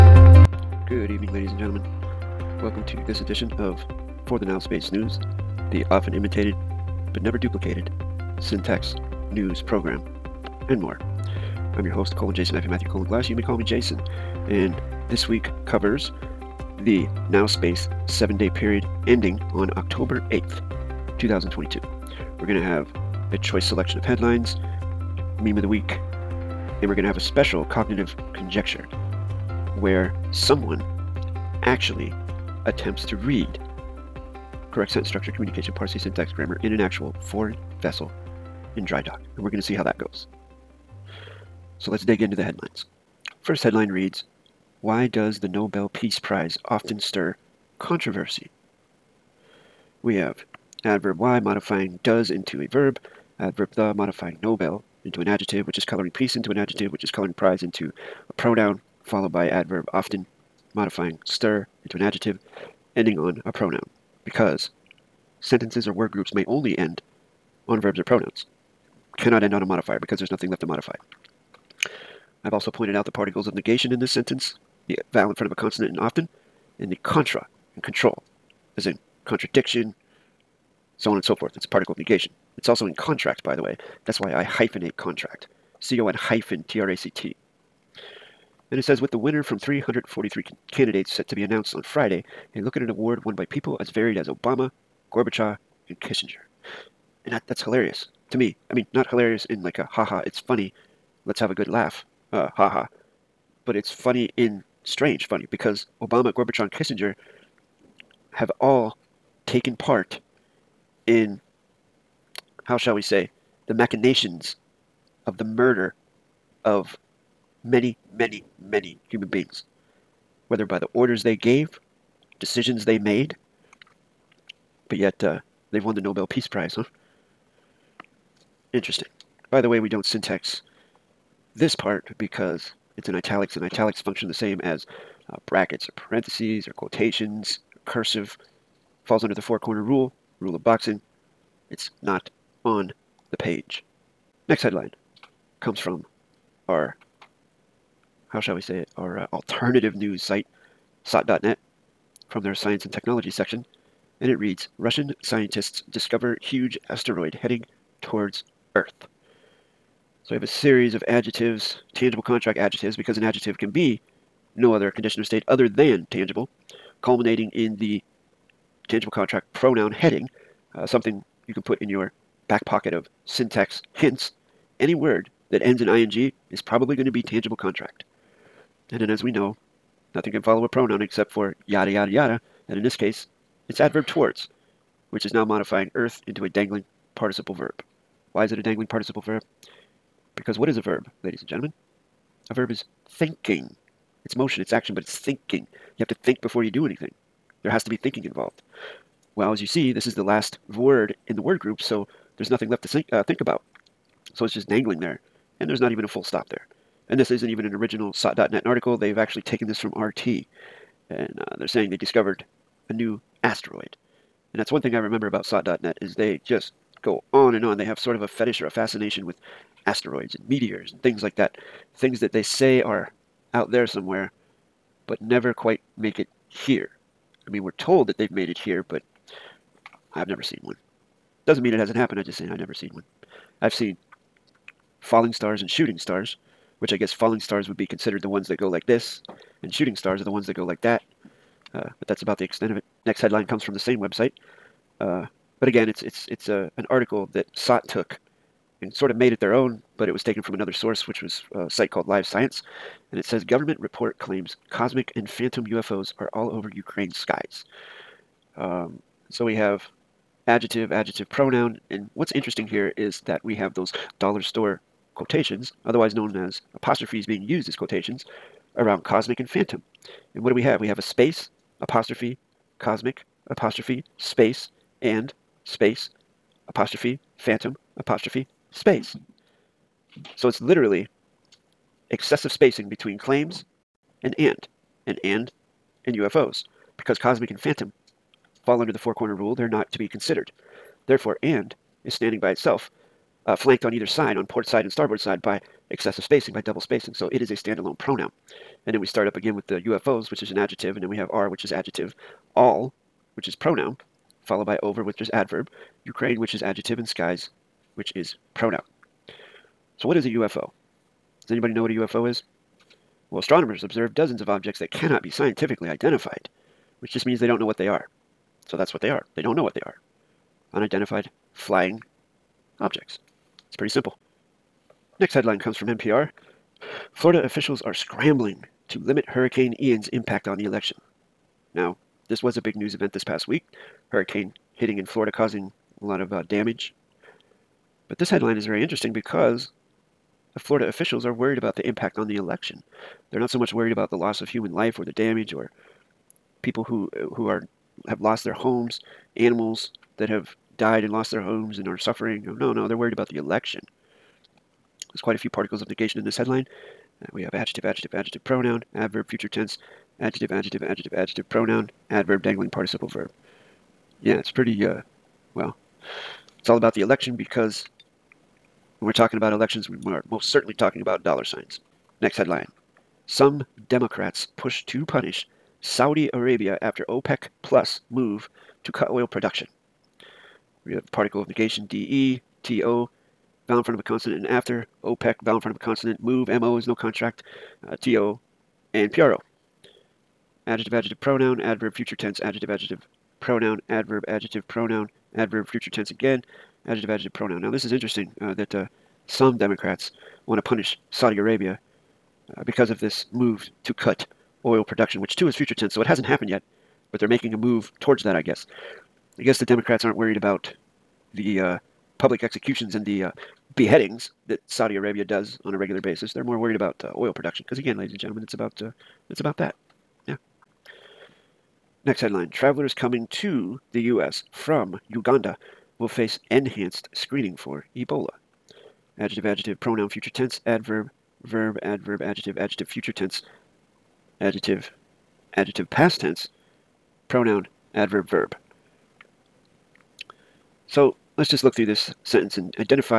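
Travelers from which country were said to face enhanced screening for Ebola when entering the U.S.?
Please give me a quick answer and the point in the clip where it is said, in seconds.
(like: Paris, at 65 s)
Uganda, at 425 s.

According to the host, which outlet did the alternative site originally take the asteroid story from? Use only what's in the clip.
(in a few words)
RT.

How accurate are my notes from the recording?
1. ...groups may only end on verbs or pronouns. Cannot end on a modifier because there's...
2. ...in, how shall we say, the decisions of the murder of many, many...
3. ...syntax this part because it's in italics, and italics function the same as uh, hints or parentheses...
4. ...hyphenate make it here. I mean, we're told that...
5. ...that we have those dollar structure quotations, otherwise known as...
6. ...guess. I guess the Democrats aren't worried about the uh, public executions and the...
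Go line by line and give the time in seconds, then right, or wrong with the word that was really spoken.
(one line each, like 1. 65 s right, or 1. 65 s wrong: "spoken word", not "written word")
1. 66 s right
2. 111 s wrong: "machinations", not "decisions"
3. 130 s wrong: "brackets", not "hints"
4. 225 s wrong: "quite", not "hyphenate"
5. 263 s wrong: "store", not "structure"
6. 408 s right.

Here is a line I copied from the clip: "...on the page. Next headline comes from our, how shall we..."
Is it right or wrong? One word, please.
right.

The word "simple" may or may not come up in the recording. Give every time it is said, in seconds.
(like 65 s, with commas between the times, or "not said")
323 s.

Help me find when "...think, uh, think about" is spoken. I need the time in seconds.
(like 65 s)
202 s.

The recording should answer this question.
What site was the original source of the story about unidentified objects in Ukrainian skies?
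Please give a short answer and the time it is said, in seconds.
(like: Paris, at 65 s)
Live Science, at 252 s.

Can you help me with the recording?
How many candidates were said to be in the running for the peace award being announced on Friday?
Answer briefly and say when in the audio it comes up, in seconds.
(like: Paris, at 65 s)
343, at 89 s.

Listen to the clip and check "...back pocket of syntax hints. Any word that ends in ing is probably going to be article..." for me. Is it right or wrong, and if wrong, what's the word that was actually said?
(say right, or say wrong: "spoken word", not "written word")
wrong: "tangible", not "article".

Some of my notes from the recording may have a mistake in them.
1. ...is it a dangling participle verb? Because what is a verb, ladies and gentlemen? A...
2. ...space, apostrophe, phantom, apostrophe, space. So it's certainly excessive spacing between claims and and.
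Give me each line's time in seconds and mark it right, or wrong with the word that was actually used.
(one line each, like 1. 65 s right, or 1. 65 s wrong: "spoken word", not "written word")
1. 188 s right
2. 275 s wrong: "literally", not "certainly".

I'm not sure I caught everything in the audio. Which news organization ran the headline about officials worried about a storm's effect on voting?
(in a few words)
NPR.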